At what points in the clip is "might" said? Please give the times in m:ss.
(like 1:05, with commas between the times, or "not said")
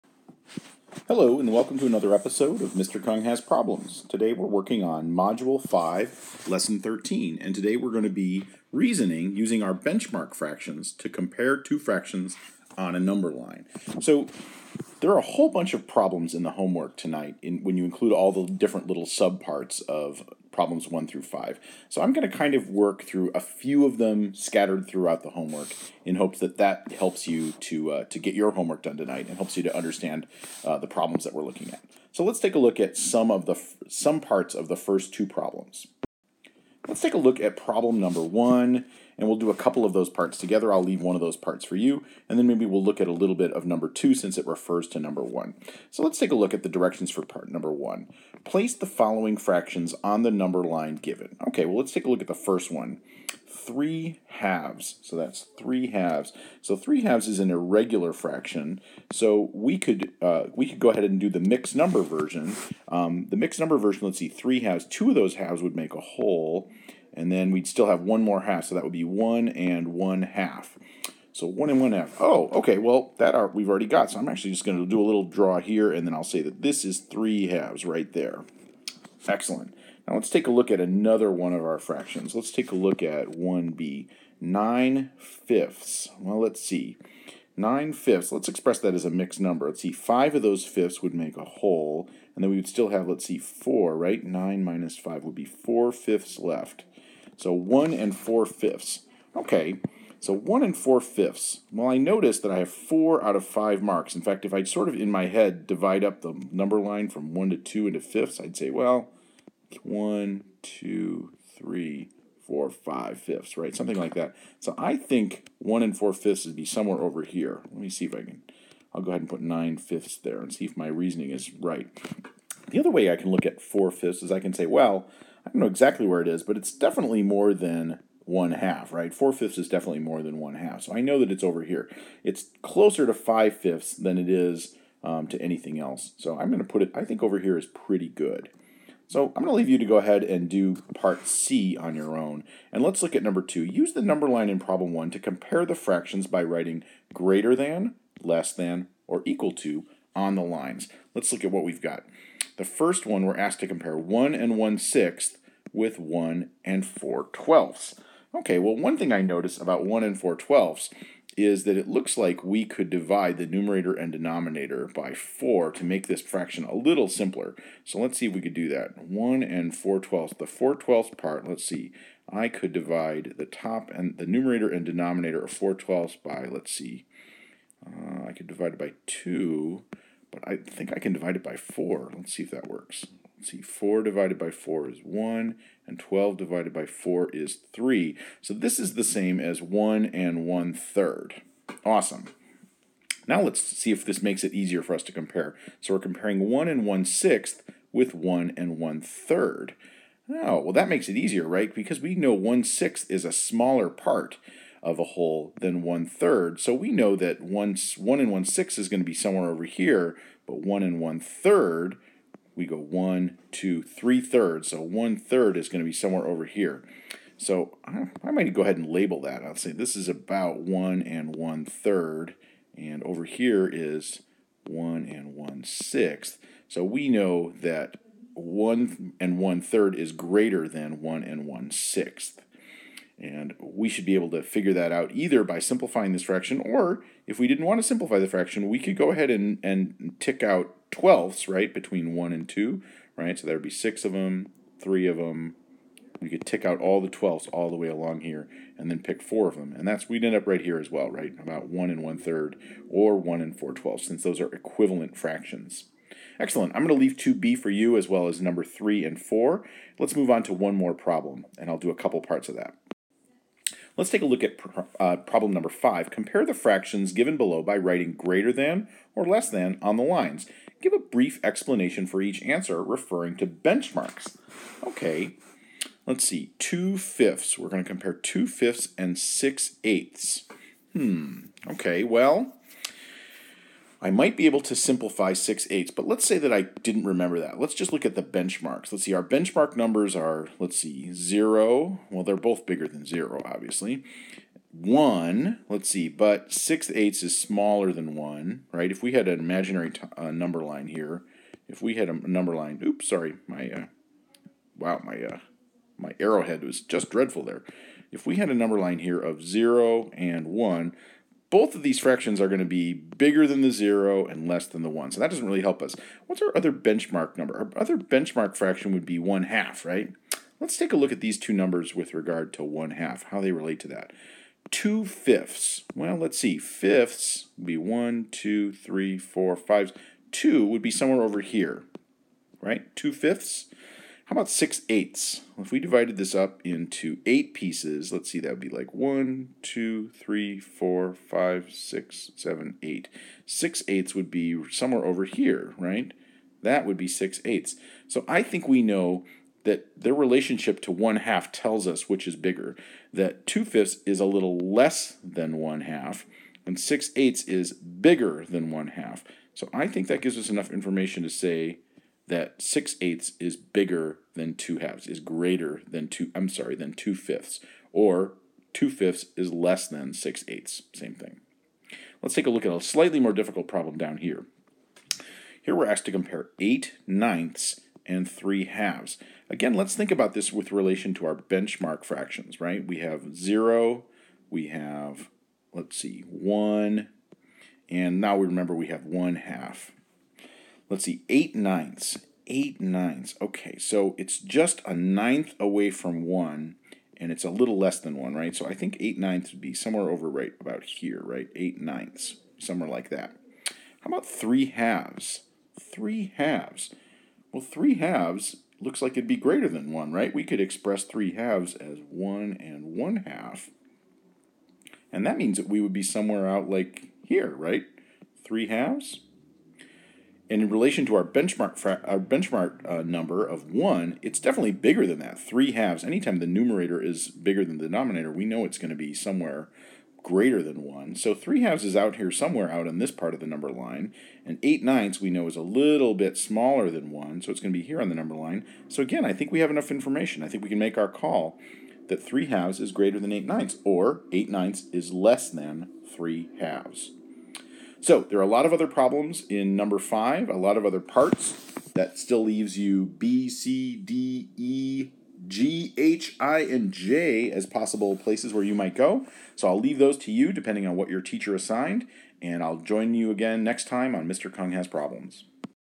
3:38, 4:44, 7:38.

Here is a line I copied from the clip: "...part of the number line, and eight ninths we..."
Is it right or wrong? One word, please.
right.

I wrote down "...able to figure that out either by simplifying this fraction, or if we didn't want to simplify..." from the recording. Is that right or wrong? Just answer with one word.
right.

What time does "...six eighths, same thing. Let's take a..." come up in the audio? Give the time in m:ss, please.
6:10.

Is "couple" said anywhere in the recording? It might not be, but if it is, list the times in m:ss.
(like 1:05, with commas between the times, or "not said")
0:39, 4:21.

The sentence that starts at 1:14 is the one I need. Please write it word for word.
So I'm actually just going to do a little draw here, and then I'll say that this is three halves right there.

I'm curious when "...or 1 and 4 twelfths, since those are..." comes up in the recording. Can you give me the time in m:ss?
4:12.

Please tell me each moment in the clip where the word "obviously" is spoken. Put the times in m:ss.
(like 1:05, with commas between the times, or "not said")
4:53.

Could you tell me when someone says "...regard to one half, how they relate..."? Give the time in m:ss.
5:22.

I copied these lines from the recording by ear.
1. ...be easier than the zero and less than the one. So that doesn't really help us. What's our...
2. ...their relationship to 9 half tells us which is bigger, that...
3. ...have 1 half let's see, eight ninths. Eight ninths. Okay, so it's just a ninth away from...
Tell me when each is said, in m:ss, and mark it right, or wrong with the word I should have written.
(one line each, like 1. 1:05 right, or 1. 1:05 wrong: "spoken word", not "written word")
1. 5:12 wrong: "bigger", not "easier"
2. 5:50 wrong: "1", not "9"
3. 6:28 right.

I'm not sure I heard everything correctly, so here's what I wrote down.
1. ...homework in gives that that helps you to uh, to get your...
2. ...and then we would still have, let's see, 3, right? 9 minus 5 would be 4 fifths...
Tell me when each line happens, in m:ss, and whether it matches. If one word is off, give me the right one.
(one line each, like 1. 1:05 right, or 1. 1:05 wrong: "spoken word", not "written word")
1. 0:25 wrong: "hopes", not "gives"
2. 1:32 wrong: "4", not "3".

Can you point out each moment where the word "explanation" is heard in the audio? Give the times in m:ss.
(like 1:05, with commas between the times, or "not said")
4:31.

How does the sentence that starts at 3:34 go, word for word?
So one third is going to be somewhere over here.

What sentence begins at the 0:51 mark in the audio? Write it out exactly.
Okay, well, let's take a look at the first one.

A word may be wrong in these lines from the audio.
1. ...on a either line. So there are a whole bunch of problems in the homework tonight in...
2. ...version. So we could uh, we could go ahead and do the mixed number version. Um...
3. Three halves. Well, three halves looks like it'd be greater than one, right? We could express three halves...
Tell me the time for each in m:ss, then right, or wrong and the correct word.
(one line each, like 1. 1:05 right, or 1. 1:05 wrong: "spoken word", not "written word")
1. 0:12 wrong: "number", not "either"
2. 0:58 wrong: "fraction", not "version"
3. 6:45 right.